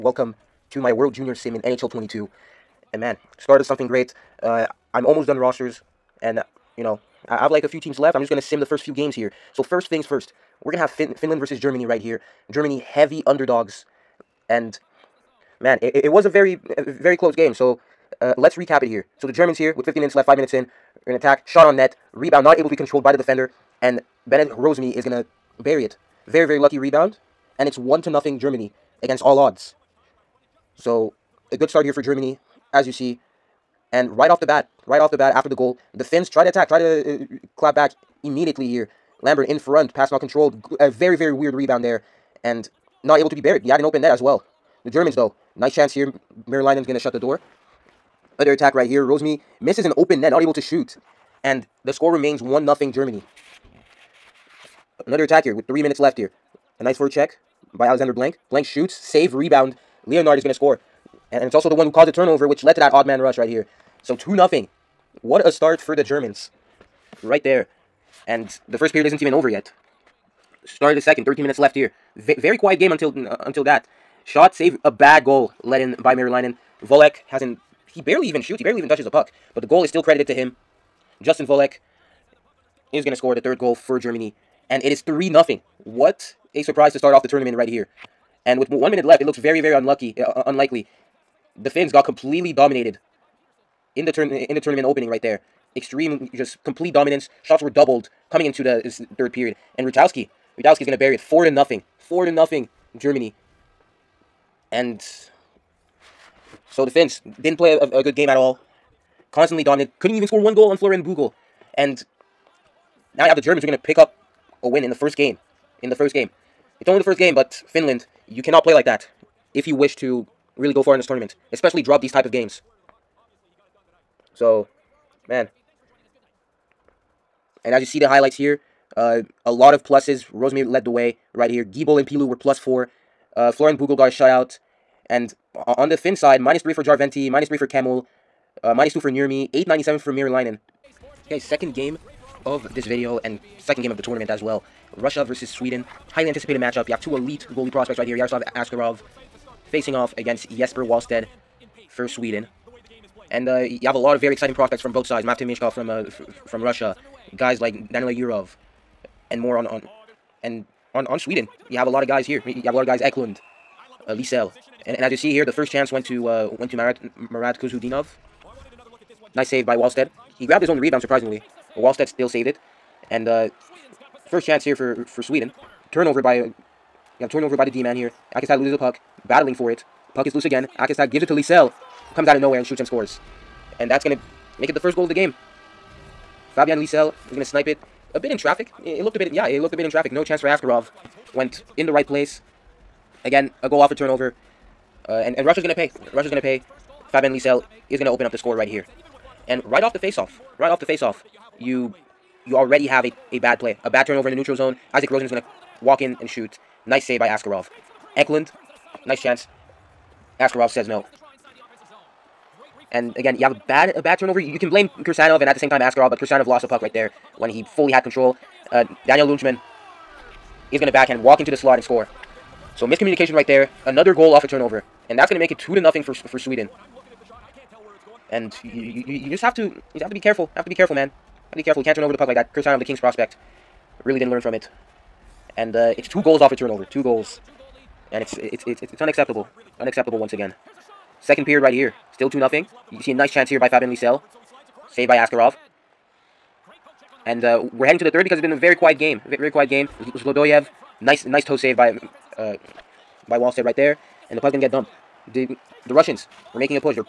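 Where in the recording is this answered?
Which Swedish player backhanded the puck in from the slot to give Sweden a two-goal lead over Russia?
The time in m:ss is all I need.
3:39.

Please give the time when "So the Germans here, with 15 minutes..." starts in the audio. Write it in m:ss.
0:19.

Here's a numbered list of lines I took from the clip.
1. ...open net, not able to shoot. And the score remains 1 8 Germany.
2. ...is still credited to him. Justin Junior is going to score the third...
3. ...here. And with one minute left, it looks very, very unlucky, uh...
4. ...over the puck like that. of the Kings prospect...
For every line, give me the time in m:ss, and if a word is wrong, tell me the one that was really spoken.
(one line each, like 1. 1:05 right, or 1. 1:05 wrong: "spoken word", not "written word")
1. 0:49 wrong: "0", not "8"
2. 1:19 wrong: "Volek", not "Junior"
3. 1:27 right
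4. 3:52 right.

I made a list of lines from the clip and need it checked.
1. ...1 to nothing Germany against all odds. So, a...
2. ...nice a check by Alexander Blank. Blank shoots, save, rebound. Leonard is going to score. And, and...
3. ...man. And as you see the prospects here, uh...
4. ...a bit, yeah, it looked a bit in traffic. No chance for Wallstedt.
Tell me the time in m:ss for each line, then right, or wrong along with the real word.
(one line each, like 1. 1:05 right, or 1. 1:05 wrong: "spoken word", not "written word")
1. 0:27 right
2. 0:56 right
3. 2:05 wrong: "highlights", not "prospects"
4. 3:09 wrong: "Askarov", not "Wallstedt".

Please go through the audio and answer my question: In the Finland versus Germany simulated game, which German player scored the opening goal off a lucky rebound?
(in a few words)
Bennett Rosemi.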